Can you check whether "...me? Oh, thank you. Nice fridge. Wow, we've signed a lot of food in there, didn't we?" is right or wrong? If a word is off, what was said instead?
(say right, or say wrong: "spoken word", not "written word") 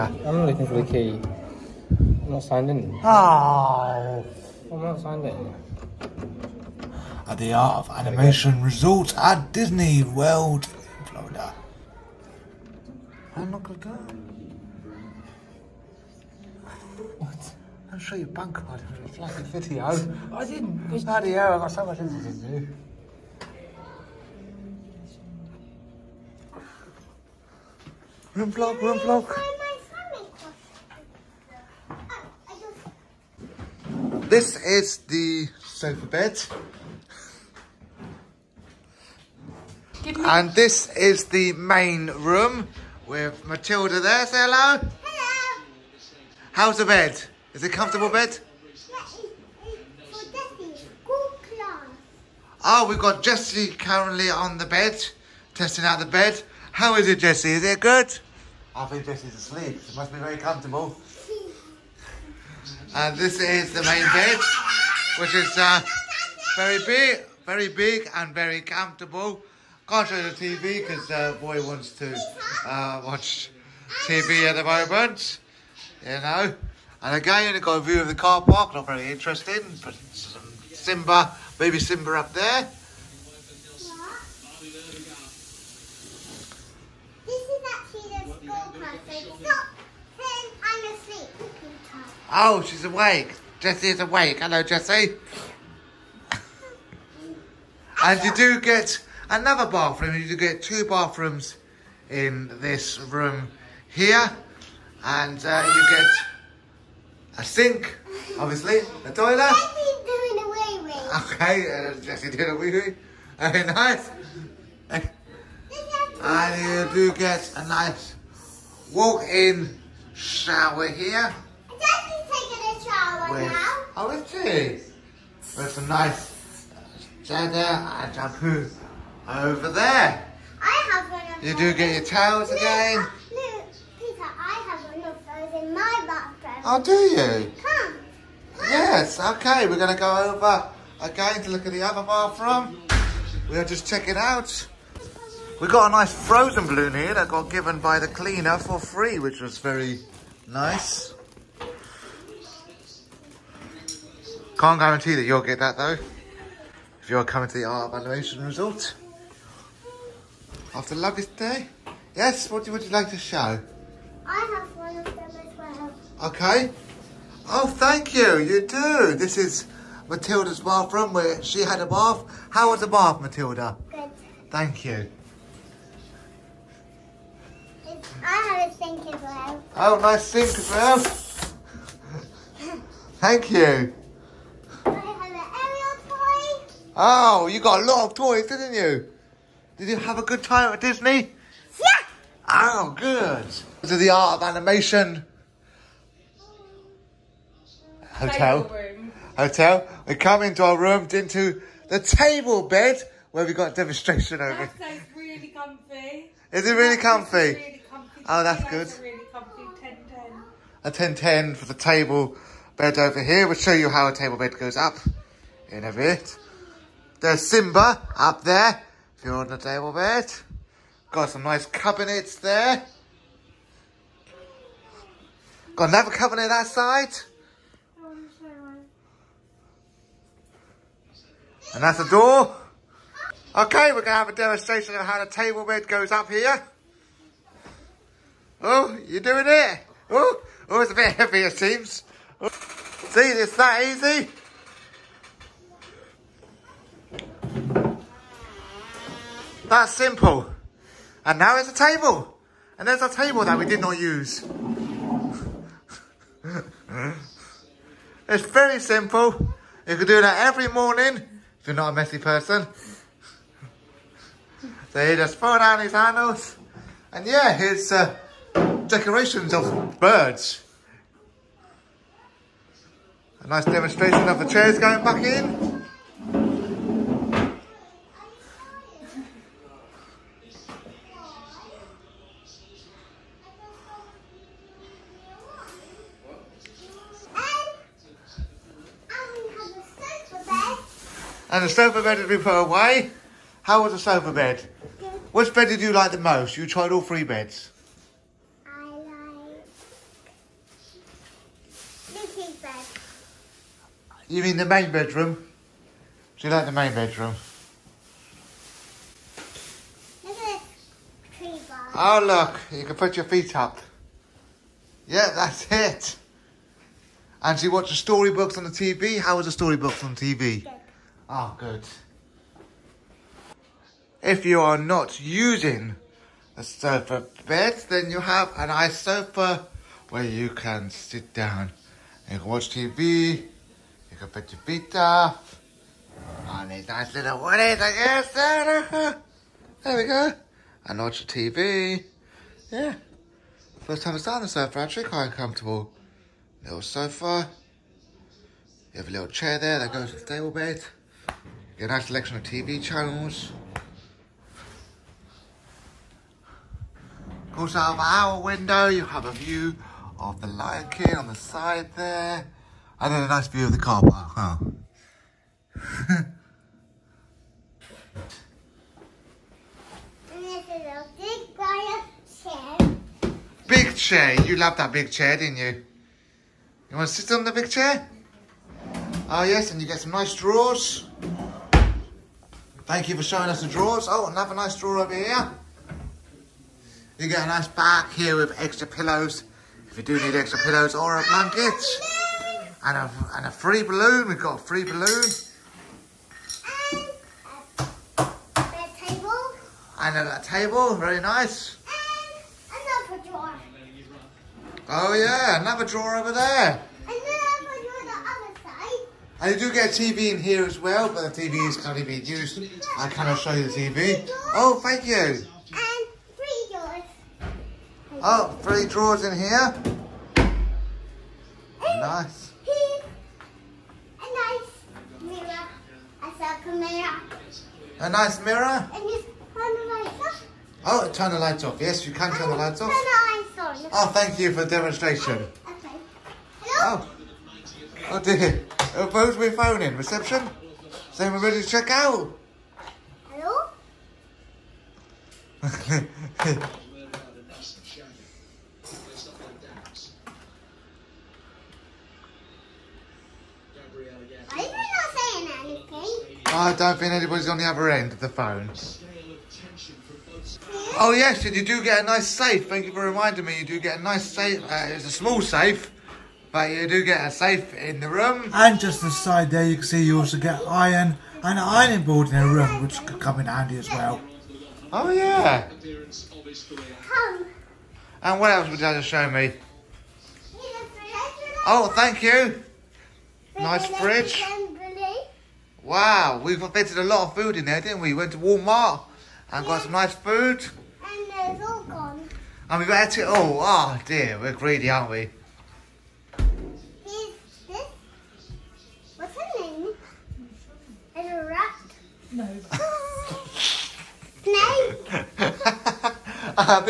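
wrong: "fitted", not "signed".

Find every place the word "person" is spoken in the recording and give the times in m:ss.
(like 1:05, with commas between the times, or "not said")
4:22.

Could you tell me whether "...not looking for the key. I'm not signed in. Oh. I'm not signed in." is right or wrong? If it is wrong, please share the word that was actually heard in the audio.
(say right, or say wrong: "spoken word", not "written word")
right.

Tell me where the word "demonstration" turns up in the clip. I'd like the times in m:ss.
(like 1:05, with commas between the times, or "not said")
3:23, 3:54, 4:33, 7:14.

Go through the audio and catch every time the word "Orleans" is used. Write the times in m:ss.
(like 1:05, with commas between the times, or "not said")
not said.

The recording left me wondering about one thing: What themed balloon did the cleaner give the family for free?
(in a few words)
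Frozen.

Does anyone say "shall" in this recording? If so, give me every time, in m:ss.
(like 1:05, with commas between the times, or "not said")
not said.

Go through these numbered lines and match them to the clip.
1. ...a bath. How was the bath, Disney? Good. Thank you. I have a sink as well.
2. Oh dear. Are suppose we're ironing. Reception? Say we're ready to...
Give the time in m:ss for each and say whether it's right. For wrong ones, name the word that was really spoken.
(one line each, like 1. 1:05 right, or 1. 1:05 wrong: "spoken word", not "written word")
1. 2:51 wrong: "Matilda", not "Disney"
2. 7:18 wrong: "phoning", not "ironing".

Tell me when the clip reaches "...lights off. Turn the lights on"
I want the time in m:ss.
7:12.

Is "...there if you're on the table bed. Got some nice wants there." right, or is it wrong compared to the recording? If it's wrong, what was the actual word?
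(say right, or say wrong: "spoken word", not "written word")
wrong: "cabinets", not "wants".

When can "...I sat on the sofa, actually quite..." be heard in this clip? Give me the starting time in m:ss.
5:44.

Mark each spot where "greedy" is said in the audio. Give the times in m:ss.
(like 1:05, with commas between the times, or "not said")
8:14.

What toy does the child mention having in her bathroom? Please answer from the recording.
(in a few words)
Ariel toy.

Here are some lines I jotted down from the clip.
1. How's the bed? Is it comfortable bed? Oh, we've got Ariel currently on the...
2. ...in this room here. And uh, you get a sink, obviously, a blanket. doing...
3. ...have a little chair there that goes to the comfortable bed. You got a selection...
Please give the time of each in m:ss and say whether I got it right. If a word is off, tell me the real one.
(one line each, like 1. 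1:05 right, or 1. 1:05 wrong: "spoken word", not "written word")
1. 0:46 wrong: "Jessie", not "Ariel"
2. 1:42 wrong: "toilet", not "blanket"
3. 5:48 wrong: "table", not "comfortable".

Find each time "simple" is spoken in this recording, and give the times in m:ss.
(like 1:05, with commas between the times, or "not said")
4:09, 4:18.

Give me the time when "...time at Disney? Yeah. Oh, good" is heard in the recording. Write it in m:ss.
3:10.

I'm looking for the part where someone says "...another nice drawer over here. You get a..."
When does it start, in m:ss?
6:24.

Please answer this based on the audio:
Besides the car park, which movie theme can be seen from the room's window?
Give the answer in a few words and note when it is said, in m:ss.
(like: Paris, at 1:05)
The Lion King, at 6:00.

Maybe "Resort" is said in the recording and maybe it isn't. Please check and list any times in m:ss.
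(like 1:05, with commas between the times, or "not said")
0:08, 2:38.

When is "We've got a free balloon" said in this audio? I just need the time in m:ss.
6:34.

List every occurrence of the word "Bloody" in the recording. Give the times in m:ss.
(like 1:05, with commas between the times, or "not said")
0:21.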